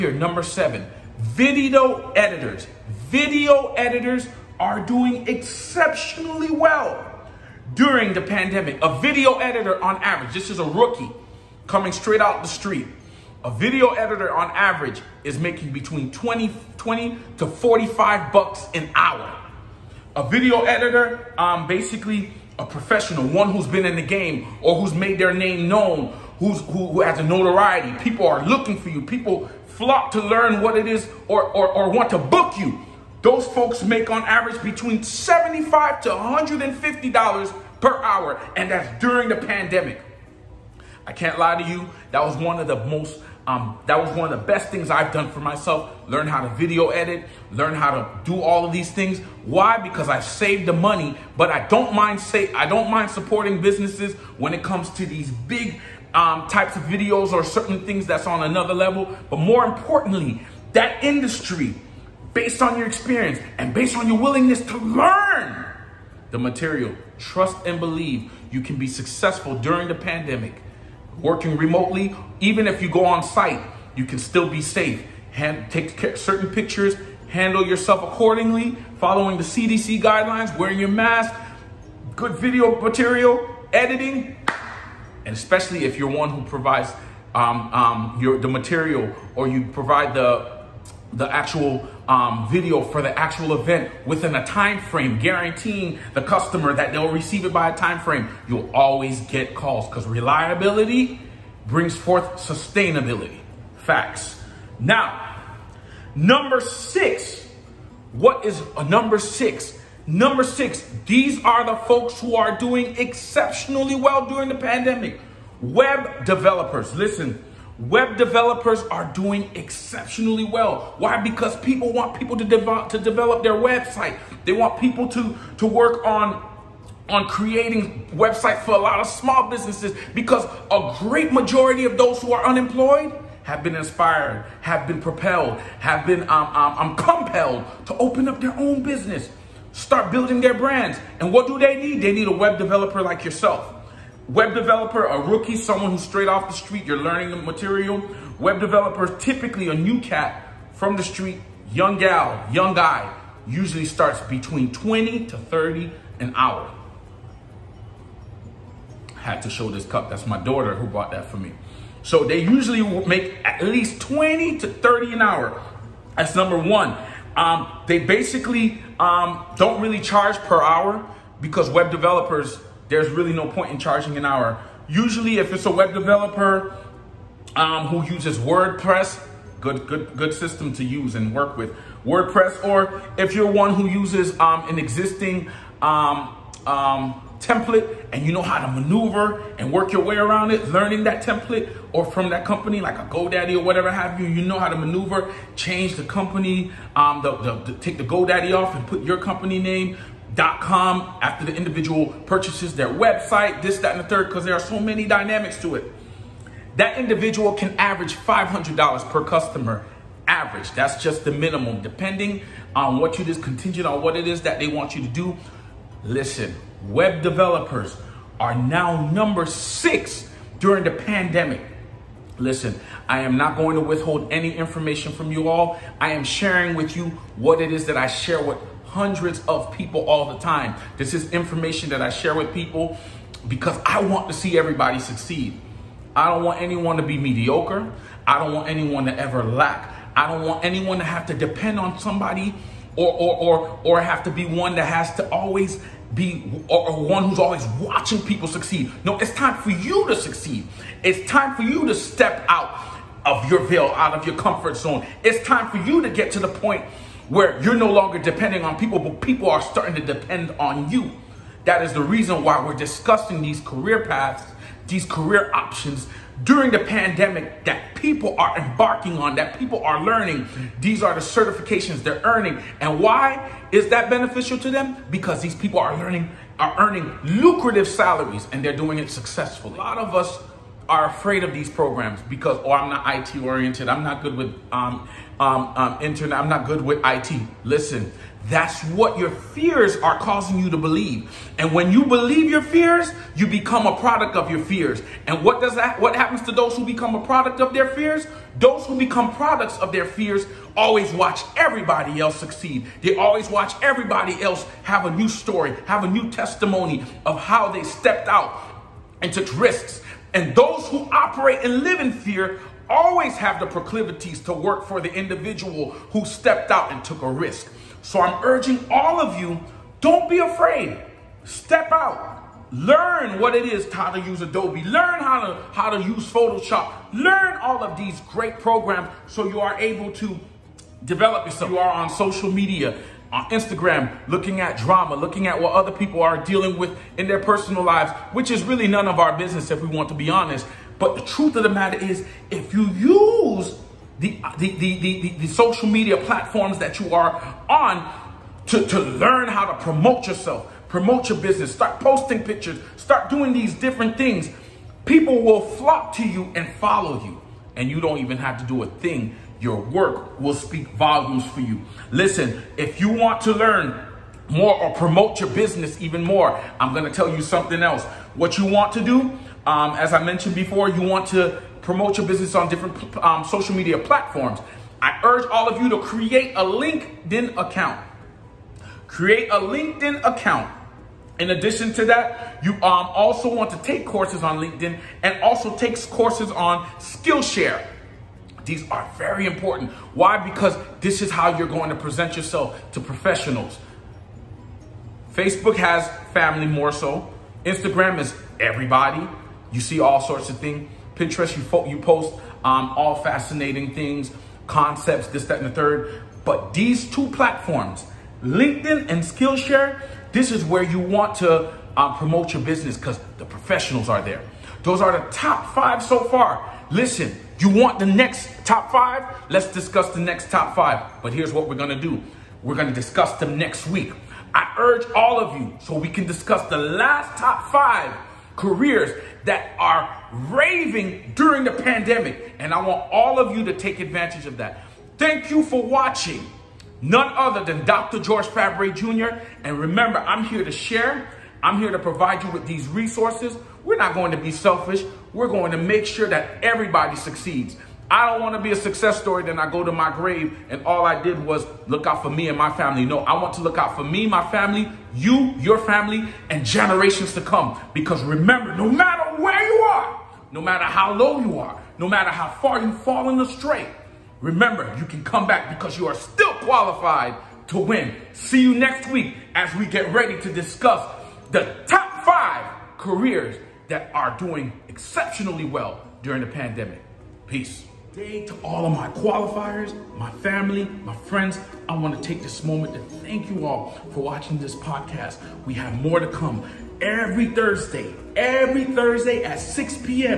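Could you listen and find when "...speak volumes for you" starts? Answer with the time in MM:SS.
06:00.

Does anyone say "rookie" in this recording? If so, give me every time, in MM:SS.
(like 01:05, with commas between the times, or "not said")
00:10, 02:25.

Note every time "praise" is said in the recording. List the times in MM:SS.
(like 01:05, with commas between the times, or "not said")
not said.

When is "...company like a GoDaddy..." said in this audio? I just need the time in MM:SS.
03:12.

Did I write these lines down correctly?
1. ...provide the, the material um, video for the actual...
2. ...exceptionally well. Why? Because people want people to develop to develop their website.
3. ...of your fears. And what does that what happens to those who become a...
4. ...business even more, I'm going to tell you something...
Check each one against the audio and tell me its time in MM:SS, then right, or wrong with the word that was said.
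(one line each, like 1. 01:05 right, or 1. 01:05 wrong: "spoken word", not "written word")
1. 01:29 wrong: "actual", not "material"
2. 01:59 right
3. 04:54 right
4. 06:05 right.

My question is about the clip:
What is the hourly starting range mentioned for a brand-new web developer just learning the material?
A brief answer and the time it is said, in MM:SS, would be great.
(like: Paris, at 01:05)
20 to 30, at 02:34.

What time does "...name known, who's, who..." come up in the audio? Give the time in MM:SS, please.
00:25.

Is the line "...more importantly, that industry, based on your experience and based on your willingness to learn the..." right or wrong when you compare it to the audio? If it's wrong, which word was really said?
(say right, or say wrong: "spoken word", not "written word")
right.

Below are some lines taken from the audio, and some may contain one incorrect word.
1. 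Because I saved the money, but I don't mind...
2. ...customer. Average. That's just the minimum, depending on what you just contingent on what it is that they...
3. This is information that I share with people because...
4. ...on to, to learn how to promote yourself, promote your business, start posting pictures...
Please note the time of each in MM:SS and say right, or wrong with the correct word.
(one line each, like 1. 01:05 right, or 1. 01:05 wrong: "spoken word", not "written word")
1. 00:49 right
2. 03:29 right
3. 03:50 right
4. 05:47 right.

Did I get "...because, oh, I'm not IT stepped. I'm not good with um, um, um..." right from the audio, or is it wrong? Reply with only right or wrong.
wrong.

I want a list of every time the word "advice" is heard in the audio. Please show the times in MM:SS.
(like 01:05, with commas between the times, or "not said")
not said.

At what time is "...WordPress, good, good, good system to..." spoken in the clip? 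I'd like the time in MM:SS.
02:58.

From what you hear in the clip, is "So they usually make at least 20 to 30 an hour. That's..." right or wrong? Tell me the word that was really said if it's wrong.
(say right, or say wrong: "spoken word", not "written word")
right.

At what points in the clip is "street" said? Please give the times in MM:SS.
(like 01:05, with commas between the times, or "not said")
00:12, 02:26, 02:31.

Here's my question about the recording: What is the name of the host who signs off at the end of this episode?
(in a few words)
Dr. George Fabre Jr.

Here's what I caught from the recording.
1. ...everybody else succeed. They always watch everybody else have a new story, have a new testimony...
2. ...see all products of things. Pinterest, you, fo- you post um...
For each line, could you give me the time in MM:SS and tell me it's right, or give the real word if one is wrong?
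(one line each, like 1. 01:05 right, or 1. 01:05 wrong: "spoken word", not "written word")
1. 05:01 right
2. 06:39 wrong: "sorts", not "products".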